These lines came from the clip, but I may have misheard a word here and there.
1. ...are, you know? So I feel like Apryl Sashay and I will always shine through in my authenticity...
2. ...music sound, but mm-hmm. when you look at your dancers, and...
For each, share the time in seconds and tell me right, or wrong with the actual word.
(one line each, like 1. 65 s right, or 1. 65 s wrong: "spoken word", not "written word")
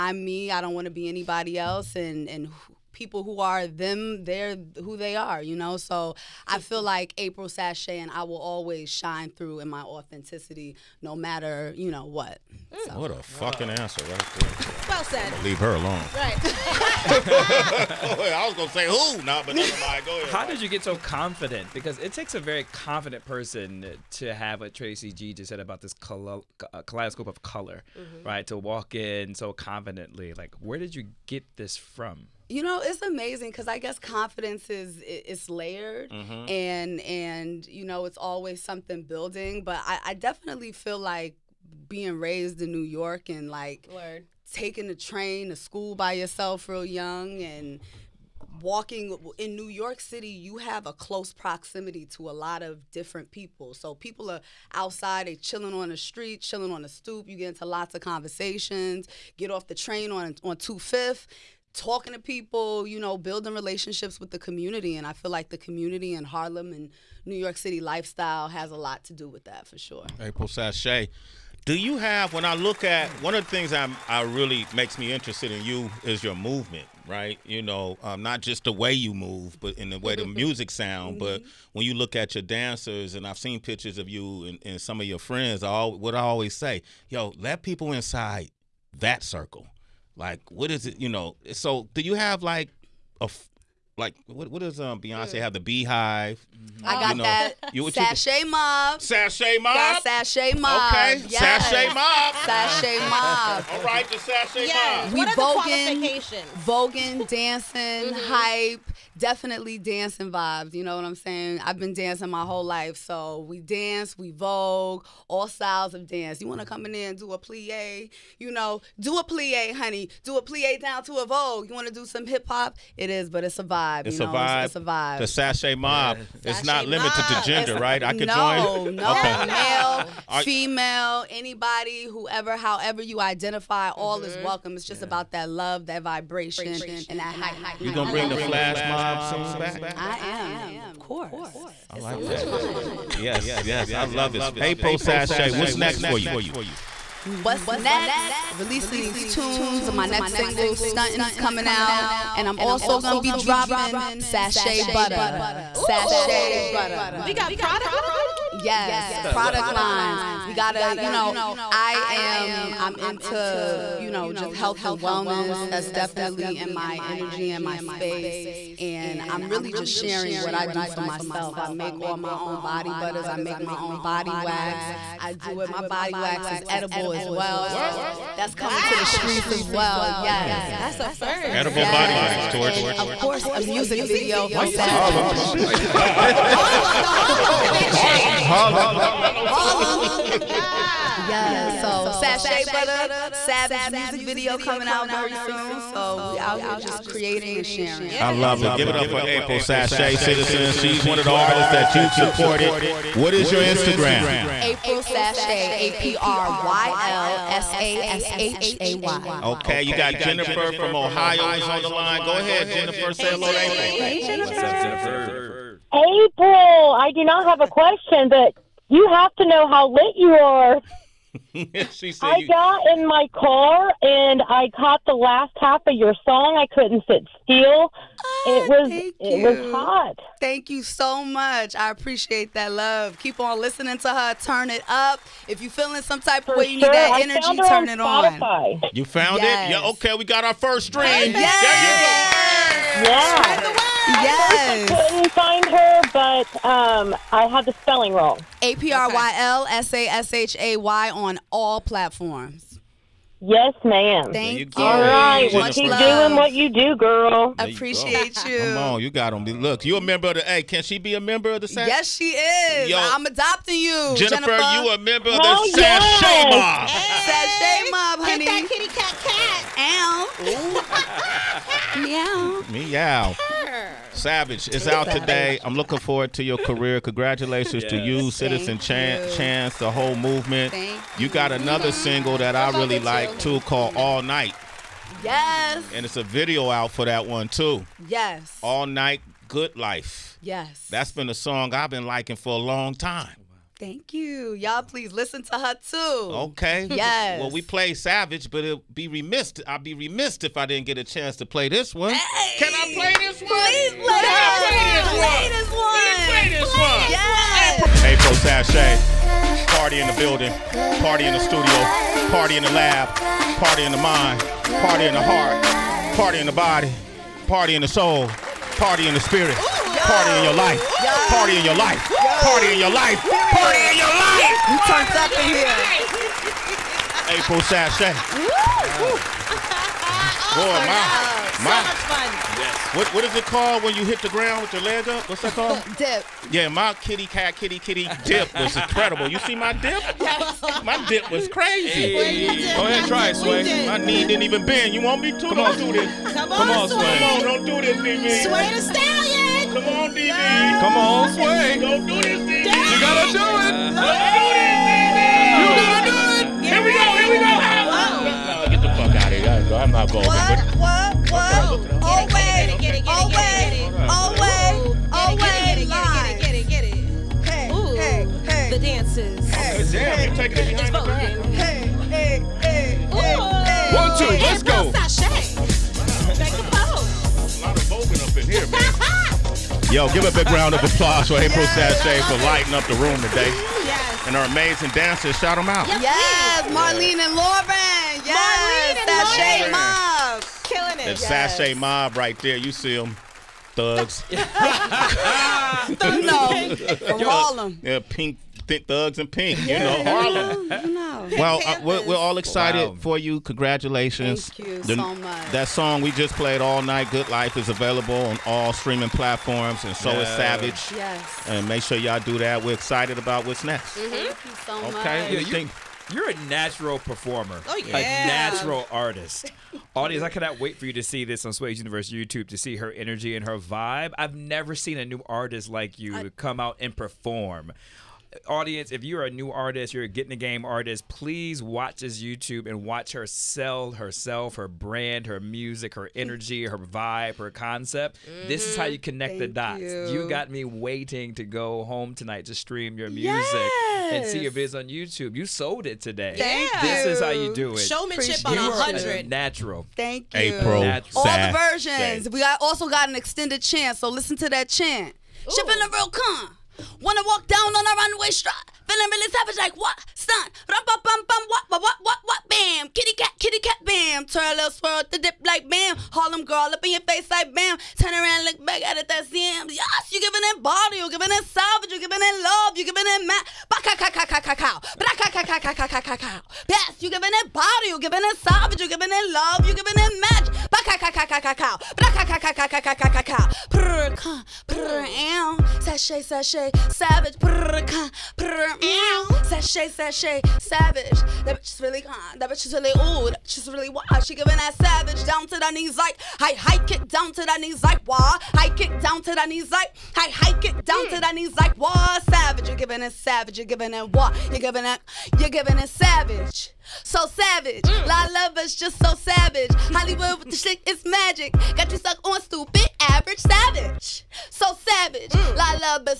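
1. 5 s right
2. 80 s right.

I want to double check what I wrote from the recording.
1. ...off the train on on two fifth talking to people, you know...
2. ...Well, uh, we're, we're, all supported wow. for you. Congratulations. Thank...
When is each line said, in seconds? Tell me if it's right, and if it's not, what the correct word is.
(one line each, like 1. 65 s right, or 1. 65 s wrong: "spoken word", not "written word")
1. 59 s right
2. 401 s wrong: "excited", not "supported".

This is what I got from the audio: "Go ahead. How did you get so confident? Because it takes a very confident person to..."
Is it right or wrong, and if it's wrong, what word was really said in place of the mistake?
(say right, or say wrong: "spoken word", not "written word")
right.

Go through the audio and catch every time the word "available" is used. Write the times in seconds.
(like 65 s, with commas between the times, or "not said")
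407 s.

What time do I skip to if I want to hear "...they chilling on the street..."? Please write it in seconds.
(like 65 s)
55 s.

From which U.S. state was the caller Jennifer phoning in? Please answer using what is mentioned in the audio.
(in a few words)
Ohio.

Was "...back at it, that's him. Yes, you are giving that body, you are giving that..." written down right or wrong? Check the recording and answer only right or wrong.
right.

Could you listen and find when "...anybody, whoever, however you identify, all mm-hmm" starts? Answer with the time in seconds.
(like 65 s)
131 s.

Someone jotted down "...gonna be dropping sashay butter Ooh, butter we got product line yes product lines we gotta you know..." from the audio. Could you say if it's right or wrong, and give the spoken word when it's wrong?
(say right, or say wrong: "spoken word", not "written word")
right.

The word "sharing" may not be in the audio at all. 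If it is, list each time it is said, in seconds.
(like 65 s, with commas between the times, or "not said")
169 s, 197 s.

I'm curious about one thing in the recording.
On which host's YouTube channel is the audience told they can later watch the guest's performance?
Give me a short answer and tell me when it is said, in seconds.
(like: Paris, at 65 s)
Sway's Universe, at 421 s.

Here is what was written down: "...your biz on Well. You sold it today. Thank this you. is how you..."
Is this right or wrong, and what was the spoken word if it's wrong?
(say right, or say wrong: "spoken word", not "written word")
wrong: "YouTube", not "Well".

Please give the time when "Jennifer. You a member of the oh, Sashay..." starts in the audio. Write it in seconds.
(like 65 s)
264 s.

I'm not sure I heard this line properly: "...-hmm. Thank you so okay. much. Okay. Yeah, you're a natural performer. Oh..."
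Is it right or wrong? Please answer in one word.
right.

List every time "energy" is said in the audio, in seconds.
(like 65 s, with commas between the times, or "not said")
166 s, 237 s, 422 s, 436 s.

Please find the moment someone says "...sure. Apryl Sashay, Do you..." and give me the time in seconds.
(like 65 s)
69 s.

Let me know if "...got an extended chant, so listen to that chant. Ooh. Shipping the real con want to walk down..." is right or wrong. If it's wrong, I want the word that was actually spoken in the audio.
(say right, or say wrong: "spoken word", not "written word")
right.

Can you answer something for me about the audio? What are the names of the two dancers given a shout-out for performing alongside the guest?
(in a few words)
Marlene and Lauren.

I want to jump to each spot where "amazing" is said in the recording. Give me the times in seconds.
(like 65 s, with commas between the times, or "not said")
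33 s, 384 s.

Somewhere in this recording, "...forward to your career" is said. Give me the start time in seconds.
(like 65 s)
275 s.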